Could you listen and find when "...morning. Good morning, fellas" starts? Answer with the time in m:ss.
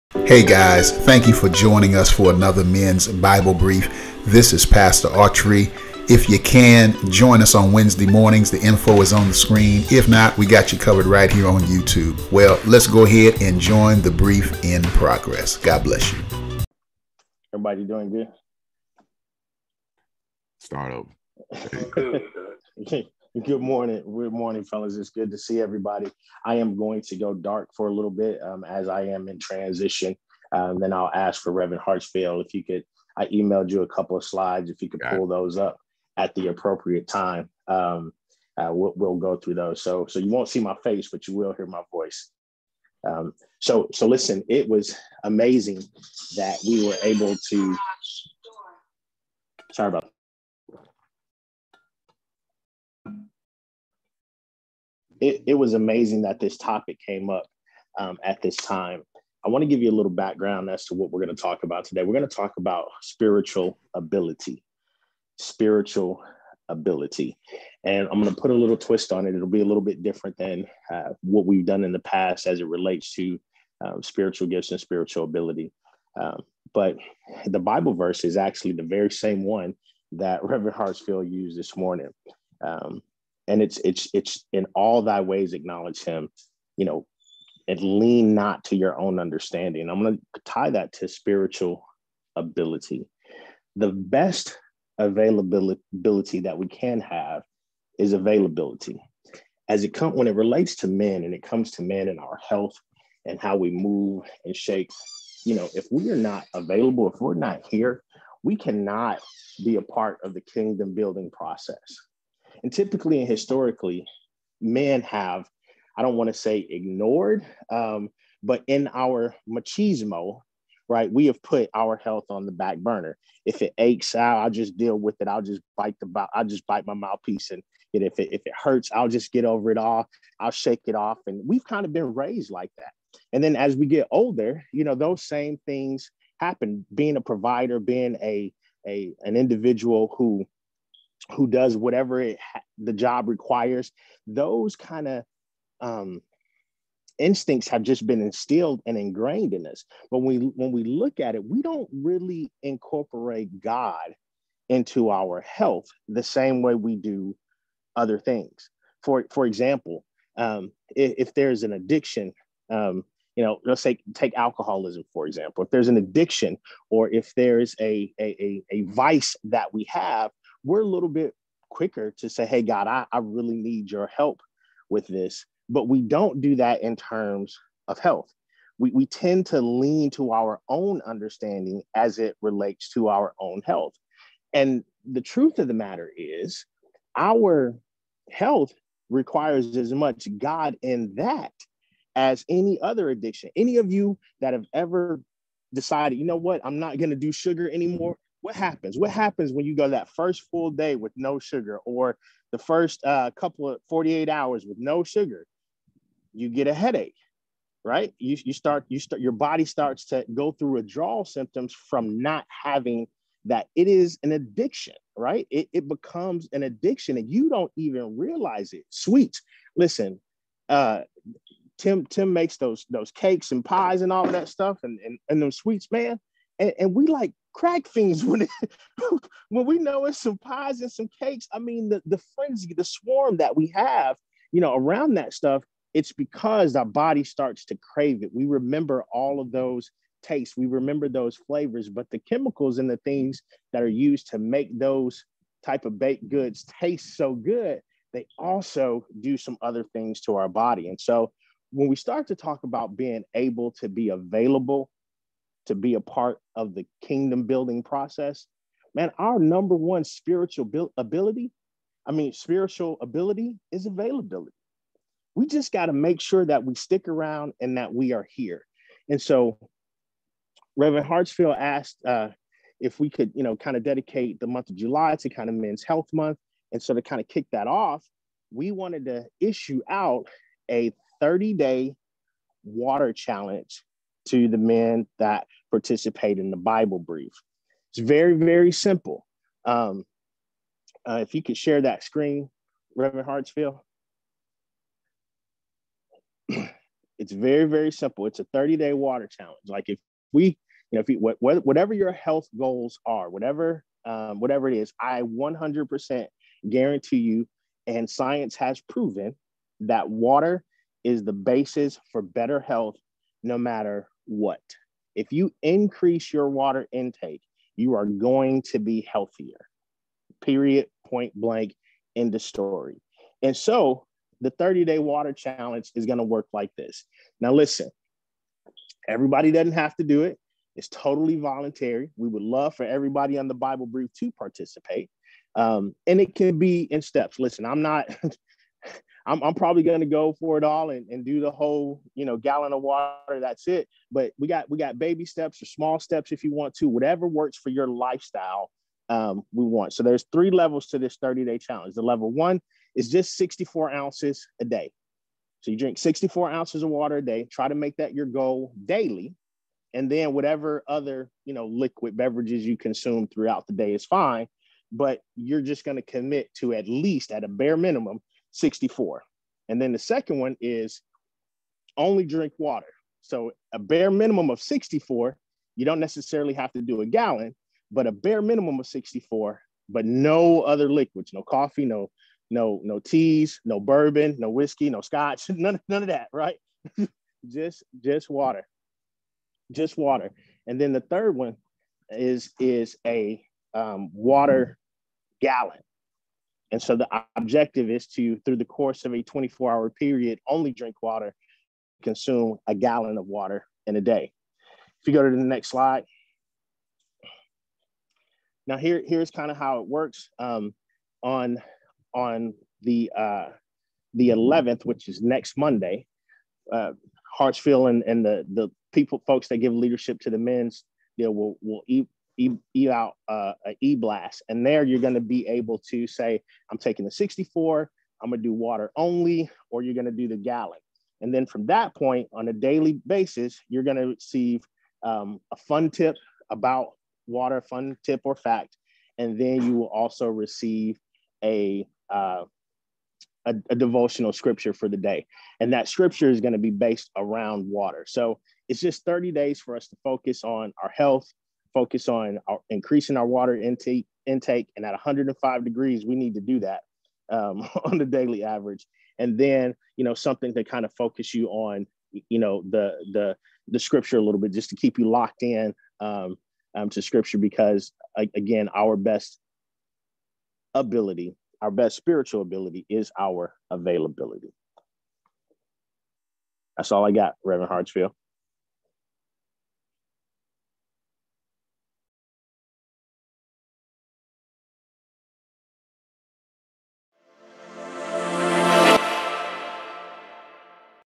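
0:23.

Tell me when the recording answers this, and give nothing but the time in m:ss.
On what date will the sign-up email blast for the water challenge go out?
6:54.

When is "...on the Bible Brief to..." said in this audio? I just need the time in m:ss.
5:33.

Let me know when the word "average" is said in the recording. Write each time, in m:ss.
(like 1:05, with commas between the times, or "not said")
7:38.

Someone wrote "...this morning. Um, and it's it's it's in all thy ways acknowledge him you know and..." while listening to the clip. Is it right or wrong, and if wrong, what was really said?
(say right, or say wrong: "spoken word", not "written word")
right.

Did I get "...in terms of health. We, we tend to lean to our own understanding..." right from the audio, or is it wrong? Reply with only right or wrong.
right.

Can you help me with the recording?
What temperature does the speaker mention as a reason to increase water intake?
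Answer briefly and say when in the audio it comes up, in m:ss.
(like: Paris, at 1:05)
105 degrees, at 7:34.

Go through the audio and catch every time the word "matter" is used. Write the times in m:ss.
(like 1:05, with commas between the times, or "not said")
3:05, 5:13.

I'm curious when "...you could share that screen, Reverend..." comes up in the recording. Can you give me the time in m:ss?
4:51.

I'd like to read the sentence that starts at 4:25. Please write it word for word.
We just got to make sure that we stick around and that we are here.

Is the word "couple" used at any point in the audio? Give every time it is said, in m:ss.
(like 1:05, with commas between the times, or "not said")
0:33, 3:23.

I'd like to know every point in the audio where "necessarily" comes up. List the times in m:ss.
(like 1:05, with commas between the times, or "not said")
6:15.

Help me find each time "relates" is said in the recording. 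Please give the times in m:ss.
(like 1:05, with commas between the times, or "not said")
1:12, 1:40, 3:02.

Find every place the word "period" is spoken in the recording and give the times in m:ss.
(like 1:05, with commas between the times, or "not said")
5:20, 6:39.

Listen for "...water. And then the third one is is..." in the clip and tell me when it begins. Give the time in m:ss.
6:29.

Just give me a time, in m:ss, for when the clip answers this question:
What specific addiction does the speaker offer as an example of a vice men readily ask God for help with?
2:44.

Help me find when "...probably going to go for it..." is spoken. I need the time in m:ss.
5:39.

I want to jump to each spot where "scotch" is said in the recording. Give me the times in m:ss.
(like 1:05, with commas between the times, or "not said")
6:24.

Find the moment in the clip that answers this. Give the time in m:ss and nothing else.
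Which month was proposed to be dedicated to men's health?
4:34.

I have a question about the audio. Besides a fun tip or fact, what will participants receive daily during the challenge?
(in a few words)
devotional scripture.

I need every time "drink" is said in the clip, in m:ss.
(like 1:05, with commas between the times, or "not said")
5:55, 6:12, 6:40.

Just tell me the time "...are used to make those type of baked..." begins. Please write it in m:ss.
4:03.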